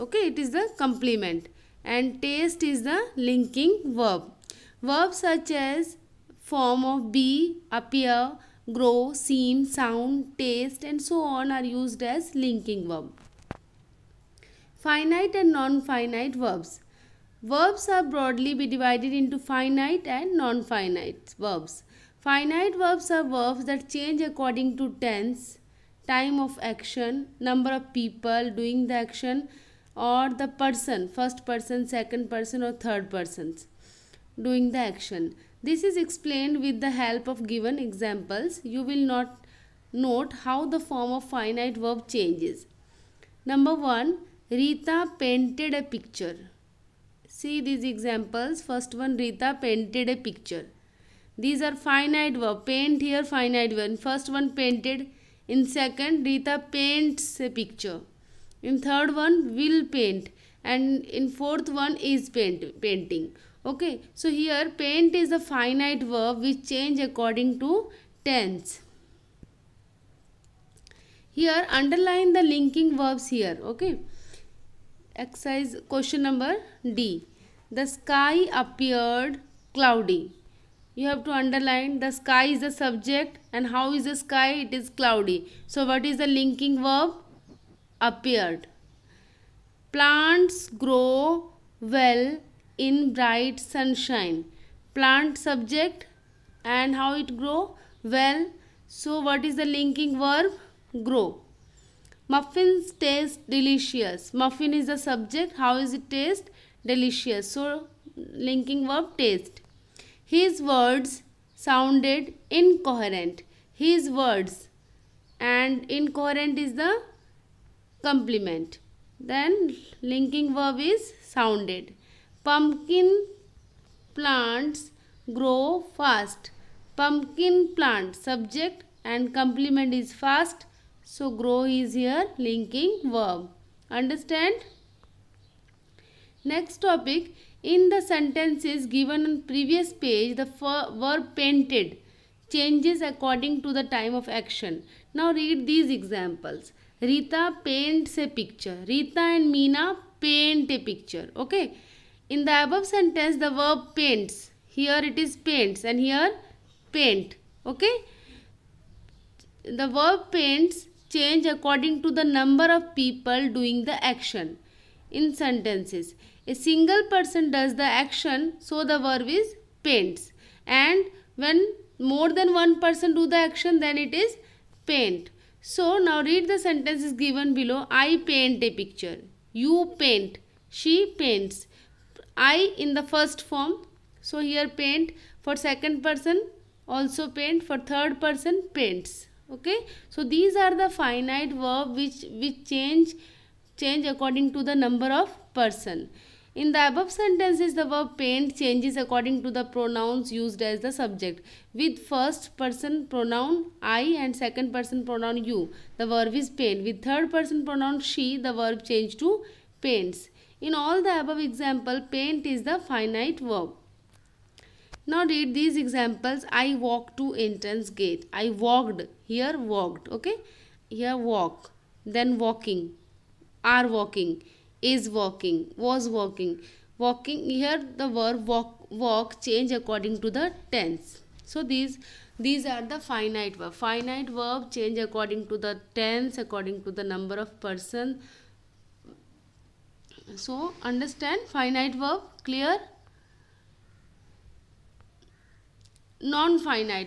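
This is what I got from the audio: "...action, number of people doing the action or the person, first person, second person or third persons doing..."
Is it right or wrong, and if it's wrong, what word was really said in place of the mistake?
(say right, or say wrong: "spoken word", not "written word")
right.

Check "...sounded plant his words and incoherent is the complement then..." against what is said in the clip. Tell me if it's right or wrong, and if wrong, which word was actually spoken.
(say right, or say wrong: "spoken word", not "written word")
wrong: "incoherent", not "plant".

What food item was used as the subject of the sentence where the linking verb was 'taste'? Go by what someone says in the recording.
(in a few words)
muffins.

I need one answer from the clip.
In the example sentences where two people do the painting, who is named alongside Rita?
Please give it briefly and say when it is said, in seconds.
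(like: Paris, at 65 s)
Meena, at 149 s.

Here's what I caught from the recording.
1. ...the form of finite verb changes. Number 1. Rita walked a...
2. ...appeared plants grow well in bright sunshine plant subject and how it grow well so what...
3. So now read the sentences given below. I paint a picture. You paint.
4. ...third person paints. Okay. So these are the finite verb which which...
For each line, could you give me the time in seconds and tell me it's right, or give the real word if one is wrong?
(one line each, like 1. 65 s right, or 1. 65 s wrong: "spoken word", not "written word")
1. 40 s wrong: "painted", not "walked"
2. 88 s right
3. 175 s right
4. 187 s right.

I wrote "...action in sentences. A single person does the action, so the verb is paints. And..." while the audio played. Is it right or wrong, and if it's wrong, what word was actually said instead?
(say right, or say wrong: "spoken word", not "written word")
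right.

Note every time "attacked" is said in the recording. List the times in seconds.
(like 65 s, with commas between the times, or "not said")
not said.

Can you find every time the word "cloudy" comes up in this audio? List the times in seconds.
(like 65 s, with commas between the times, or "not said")
79 s, 85 s.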